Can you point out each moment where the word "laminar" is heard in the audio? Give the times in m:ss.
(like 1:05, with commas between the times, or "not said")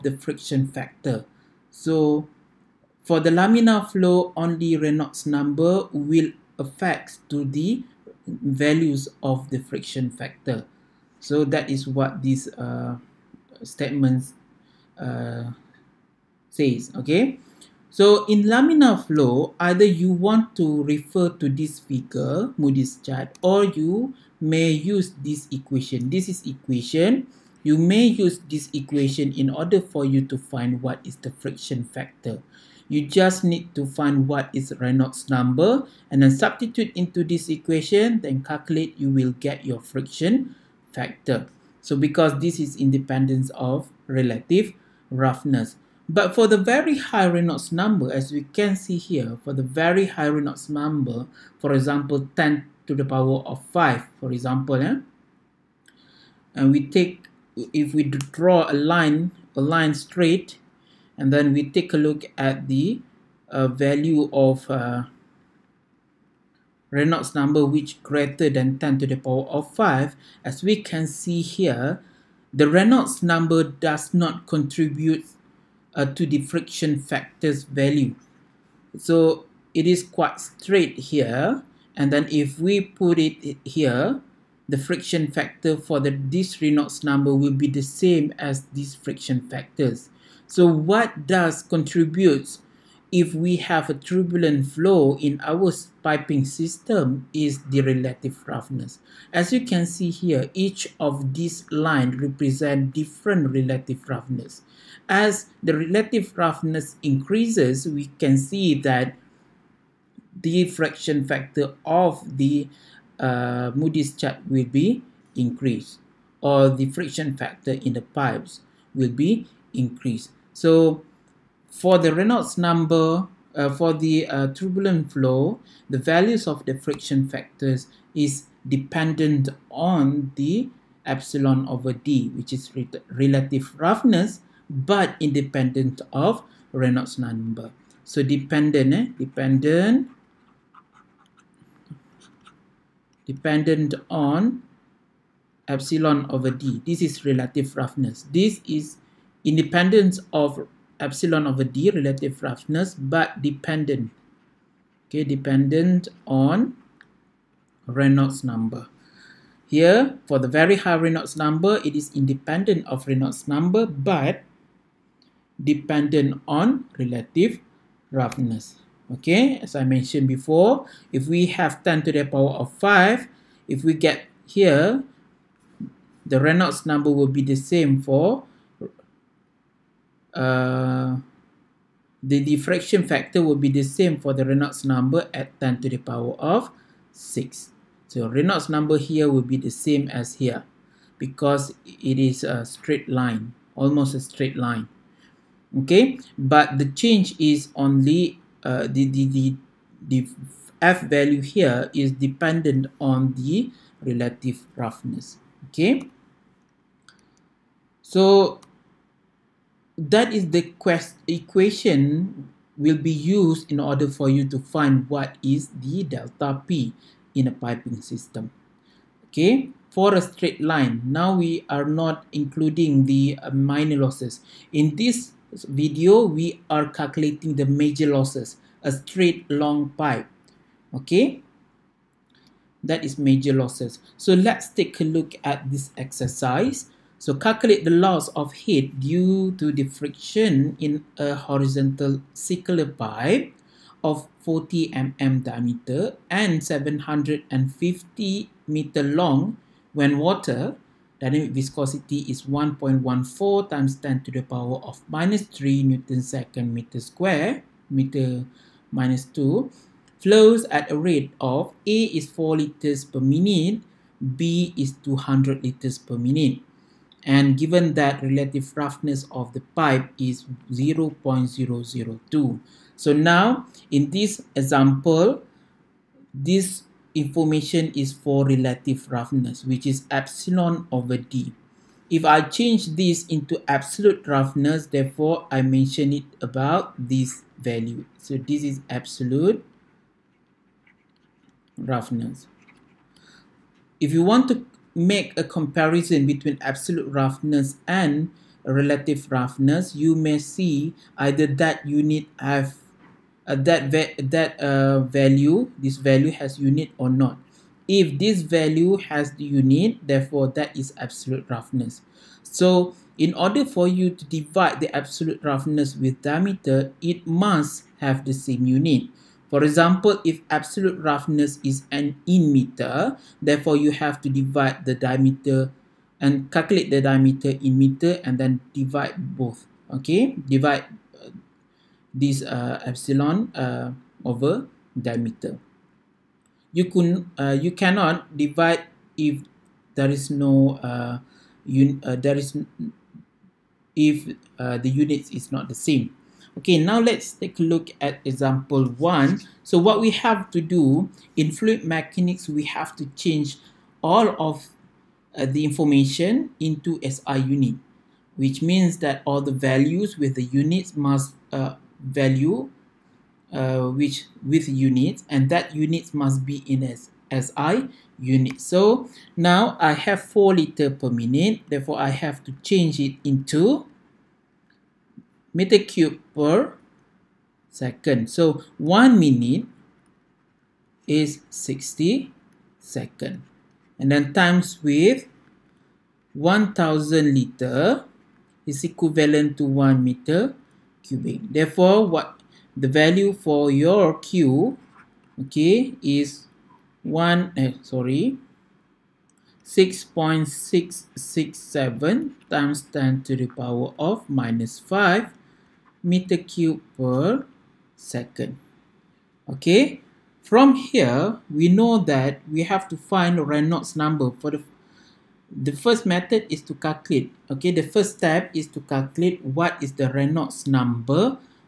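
0:03, 0:18.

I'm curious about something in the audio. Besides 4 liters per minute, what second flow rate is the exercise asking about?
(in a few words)
200 liters per minute.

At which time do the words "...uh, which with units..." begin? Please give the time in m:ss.
6:03.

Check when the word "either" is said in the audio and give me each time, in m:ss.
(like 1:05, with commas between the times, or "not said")
0:19, 5:01.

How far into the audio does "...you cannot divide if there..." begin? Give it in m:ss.
5:37.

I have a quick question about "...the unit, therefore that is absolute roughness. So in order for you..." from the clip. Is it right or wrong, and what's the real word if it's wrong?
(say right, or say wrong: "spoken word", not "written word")
right.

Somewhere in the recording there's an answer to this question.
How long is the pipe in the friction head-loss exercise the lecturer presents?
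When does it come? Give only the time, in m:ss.
4:06.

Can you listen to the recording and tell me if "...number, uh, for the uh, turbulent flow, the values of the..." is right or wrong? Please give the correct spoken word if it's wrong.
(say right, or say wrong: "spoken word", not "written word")
right.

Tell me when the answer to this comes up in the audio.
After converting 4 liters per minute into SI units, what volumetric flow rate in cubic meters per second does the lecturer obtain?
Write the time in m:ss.
6:39.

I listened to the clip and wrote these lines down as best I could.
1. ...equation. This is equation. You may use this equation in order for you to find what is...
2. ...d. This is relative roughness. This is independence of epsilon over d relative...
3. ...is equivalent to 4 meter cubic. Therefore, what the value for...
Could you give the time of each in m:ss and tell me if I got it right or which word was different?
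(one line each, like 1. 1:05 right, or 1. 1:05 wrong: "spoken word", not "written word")
1. 0:25 right
2. 2:26 right
3. 6:28 wrong: "1", not "4".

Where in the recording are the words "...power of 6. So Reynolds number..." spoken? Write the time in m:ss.
3:05.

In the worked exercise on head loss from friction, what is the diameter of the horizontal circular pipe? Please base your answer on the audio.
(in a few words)
40 mm.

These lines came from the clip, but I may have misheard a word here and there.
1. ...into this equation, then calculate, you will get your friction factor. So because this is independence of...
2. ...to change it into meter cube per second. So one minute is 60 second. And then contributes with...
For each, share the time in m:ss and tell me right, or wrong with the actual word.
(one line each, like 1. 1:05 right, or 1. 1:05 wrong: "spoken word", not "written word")
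1. 0:36 right
2. 6:12 wrong: "times", not "contributes".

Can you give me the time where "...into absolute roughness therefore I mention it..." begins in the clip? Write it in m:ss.
4:43.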